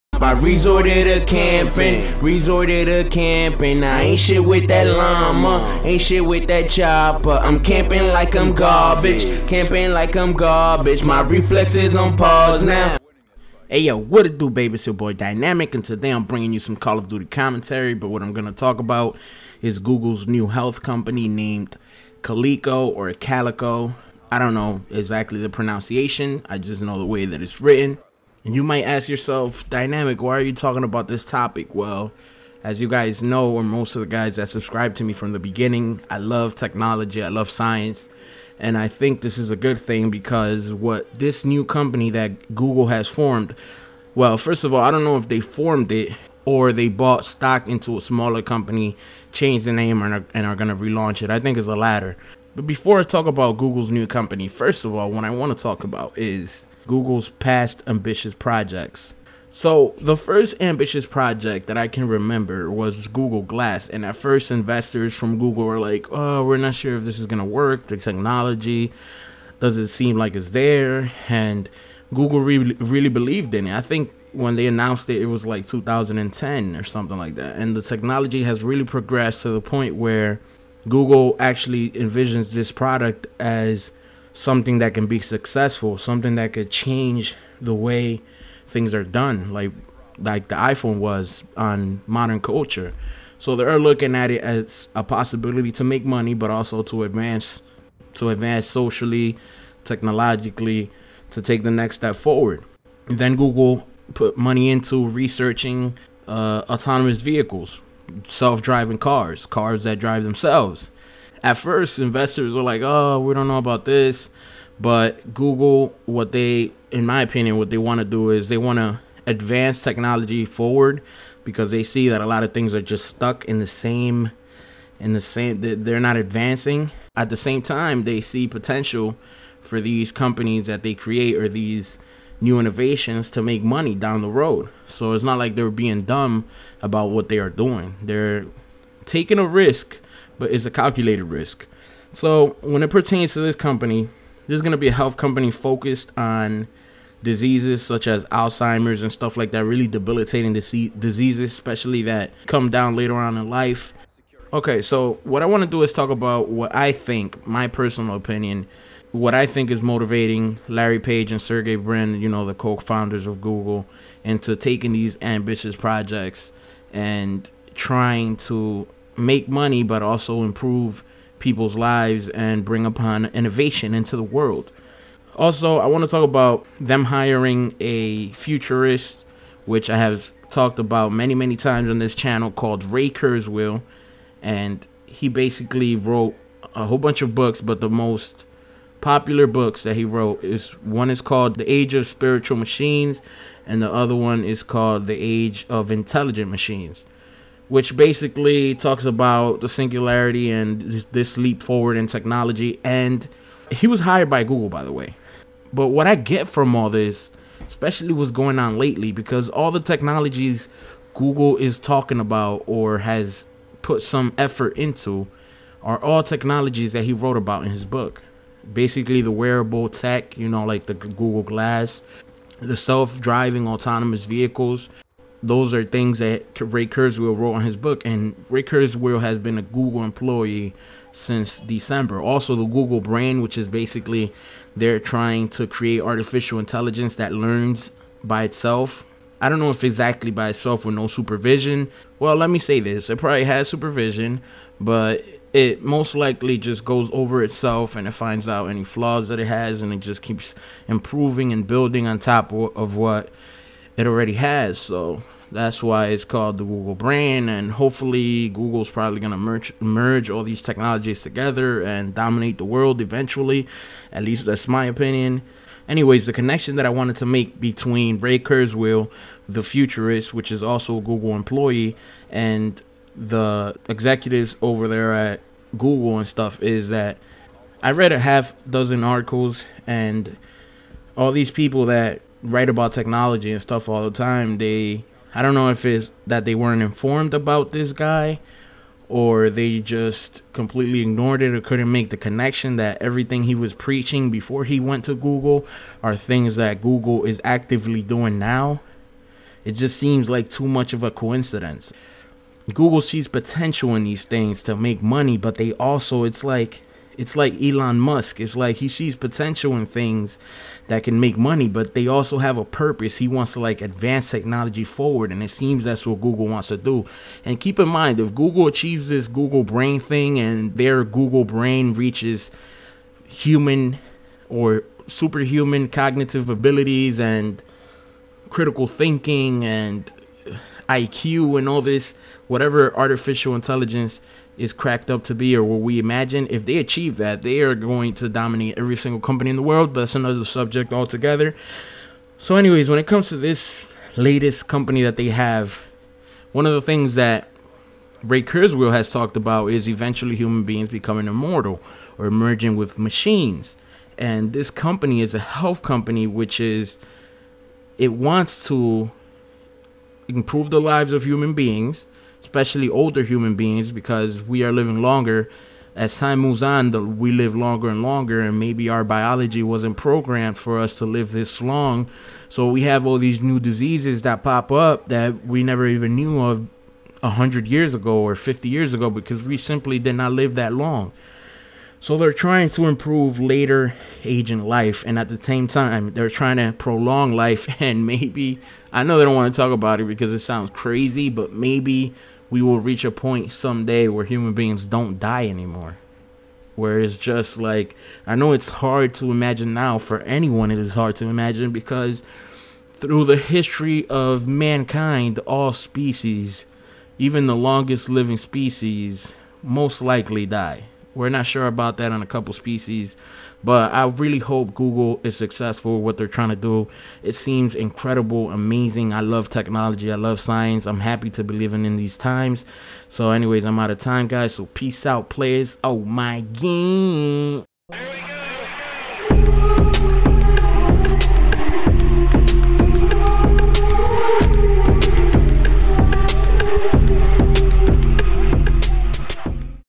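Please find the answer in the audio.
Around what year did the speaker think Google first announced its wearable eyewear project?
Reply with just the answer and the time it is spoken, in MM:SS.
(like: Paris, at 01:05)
2010, at 01:15.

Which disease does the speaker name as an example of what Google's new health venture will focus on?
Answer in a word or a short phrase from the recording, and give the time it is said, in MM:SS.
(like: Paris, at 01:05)
Alzheimer's, at 02:28.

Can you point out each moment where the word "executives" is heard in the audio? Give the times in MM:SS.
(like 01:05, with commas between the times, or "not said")
04:33.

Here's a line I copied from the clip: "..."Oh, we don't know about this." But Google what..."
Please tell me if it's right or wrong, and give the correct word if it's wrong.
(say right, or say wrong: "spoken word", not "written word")
right.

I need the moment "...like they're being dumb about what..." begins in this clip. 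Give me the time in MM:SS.
02:15.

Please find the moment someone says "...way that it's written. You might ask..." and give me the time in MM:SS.
00:27.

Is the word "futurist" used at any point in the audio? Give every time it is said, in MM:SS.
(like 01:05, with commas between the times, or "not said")
02:58, 04:29.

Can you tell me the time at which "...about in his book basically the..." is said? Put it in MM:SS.
03:37.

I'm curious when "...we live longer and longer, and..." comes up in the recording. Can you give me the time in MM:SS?
06:07.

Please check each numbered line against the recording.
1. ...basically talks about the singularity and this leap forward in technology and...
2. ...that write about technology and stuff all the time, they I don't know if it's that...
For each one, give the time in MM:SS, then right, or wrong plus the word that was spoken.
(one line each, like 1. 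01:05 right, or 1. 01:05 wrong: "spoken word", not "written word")
1. 03:17 right
2. 04:41 right.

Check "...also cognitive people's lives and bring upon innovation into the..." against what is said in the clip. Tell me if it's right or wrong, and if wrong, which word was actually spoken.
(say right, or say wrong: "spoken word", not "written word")
wrong: "improve", not "cognitive".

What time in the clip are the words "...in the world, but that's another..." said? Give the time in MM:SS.
05:39.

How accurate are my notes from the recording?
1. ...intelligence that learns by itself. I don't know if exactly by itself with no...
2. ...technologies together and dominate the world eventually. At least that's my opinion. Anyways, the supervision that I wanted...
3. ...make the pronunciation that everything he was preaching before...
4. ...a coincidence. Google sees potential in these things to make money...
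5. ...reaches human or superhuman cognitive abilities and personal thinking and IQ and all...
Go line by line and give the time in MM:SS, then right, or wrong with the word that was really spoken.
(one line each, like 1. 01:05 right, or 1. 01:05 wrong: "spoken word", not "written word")
1. 03:56 right
2. 04:20 wrong: "connection", not "supervision"
3. 04:51 wrong: "connection", not "pronunciation"
4. 05:01 right
5. 05:21 wrong: "critical", not "personal".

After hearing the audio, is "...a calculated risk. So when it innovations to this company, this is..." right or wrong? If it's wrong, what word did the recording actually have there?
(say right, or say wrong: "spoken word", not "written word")
wrong: "pertains", not "innovations".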